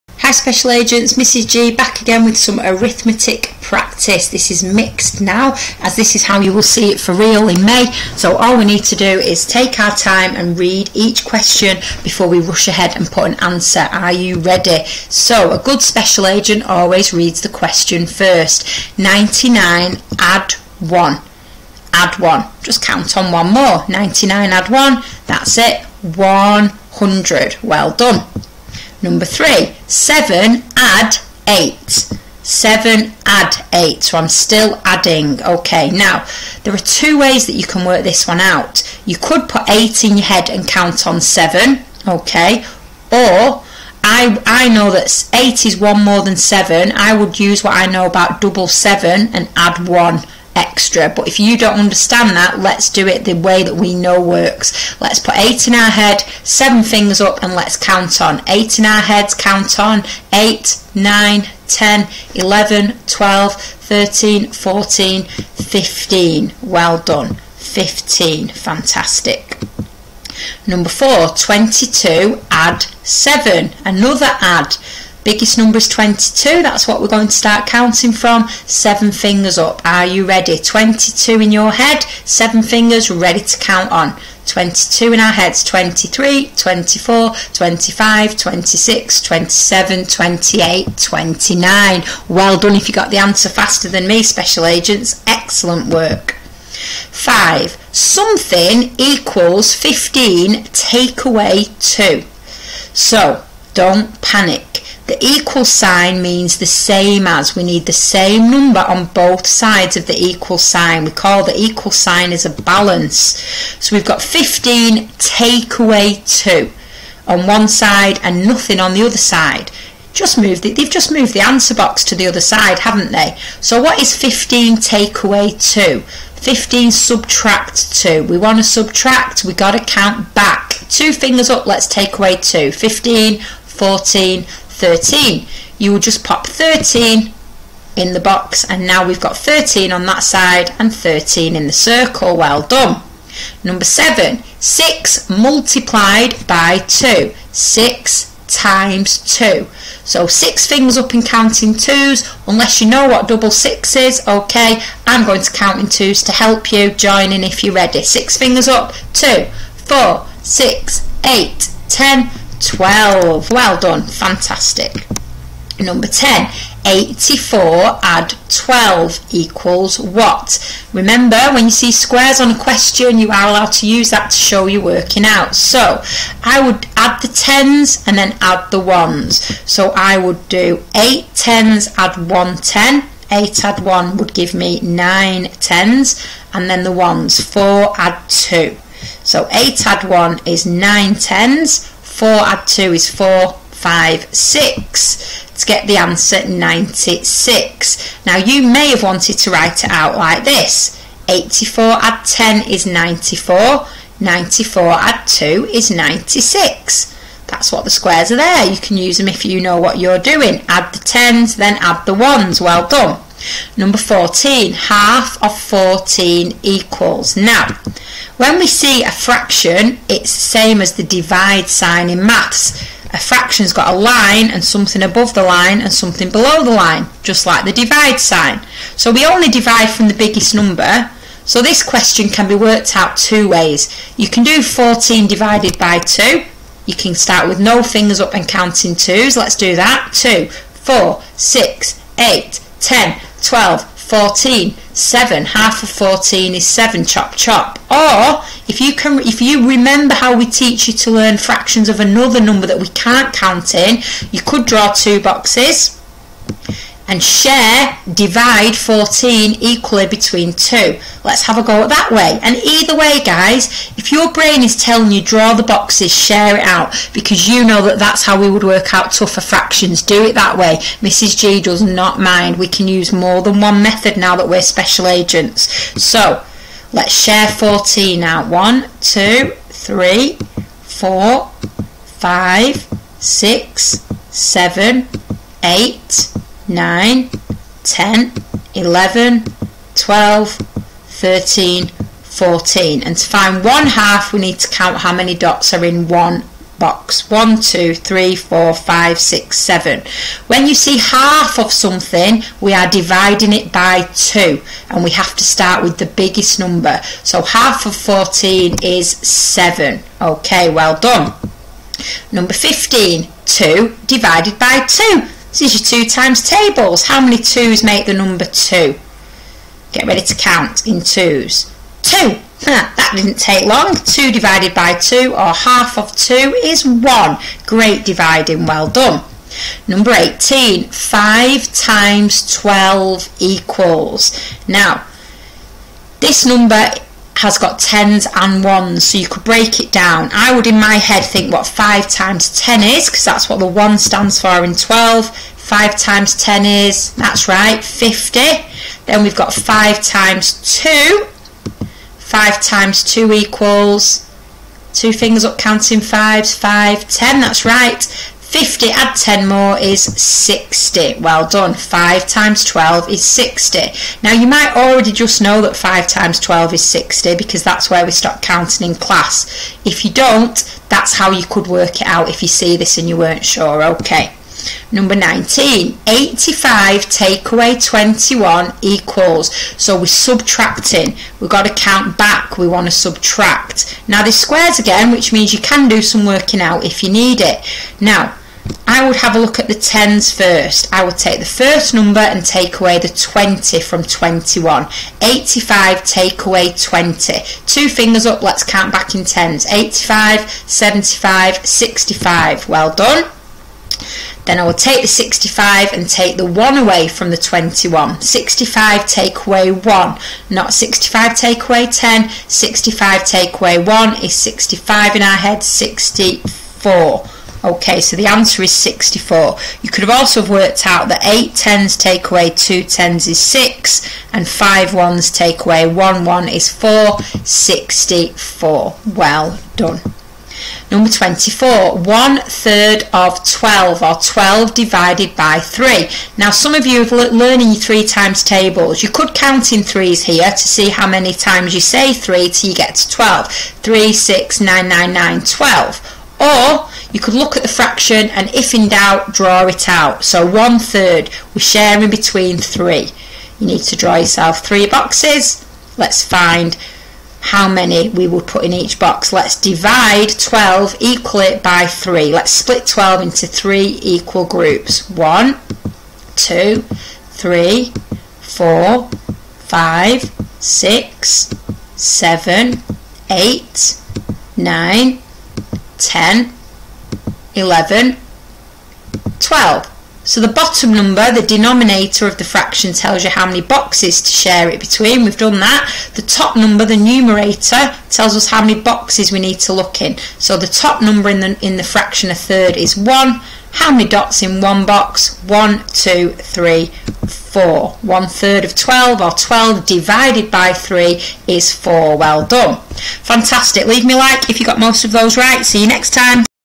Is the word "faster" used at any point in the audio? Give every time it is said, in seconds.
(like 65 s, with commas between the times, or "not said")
93 s.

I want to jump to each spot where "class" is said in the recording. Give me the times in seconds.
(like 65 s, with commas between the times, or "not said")
368 s.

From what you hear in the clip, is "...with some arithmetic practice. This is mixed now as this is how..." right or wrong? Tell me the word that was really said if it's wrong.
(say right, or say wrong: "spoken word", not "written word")
right.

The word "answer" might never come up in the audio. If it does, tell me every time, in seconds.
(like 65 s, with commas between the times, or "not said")
13 s, 93 s, 121 s, 195 s, 418 s.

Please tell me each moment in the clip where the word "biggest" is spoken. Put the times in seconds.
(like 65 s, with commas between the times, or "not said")
75 s, 230 s, 306 s.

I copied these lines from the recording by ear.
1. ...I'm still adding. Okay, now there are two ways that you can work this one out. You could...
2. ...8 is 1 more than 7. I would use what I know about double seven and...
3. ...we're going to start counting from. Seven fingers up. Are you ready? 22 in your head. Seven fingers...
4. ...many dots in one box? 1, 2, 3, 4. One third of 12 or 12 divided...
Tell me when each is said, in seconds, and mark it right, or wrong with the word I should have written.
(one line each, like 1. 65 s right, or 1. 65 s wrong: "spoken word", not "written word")
1. 34 s right
2. 45 s right
3. 76 s right
4. 493 s right.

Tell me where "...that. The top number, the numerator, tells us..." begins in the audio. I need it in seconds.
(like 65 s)
485 s.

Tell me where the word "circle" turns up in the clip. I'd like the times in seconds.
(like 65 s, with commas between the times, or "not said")
141 s.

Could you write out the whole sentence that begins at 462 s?
Let's split 12 into 3 equal groups.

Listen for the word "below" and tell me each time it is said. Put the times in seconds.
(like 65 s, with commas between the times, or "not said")
226 s.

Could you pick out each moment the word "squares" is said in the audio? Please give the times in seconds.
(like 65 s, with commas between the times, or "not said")
171 s, 207 s, 384 s.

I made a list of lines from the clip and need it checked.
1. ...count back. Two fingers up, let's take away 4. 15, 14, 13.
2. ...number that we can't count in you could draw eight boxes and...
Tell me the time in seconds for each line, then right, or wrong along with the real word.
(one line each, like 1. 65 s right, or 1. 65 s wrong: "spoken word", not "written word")
1. 129 s wrong: "2", not "4"
2. 252 s wrong: "two", not "eight".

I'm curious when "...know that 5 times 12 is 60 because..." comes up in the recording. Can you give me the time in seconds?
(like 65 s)
365 s.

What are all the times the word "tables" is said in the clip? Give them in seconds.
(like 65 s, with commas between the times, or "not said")
316 s, 438 s.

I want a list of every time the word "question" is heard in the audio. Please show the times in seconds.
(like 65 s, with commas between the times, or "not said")
11 s, 17 s, 172 s, 231 s.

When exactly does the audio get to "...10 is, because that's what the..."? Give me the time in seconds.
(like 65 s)
342 s.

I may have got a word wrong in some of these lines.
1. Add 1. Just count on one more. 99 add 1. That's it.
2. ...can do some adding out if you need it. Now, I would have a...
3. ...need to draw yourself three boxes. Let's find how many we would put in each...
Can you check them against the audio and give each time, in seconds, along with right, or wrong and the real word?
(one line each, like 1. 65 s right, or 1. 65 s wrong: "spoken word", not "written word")
1. 21 s right
2. 385 s wrong: "working", not "adding"
3. 453 s right.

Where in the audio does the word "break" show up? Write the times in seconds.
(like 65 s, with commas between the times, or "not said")
339 s.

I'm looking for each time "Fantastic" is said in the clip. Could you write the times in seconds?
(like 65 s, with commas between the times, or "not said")
68 s, 164 s, 503 s.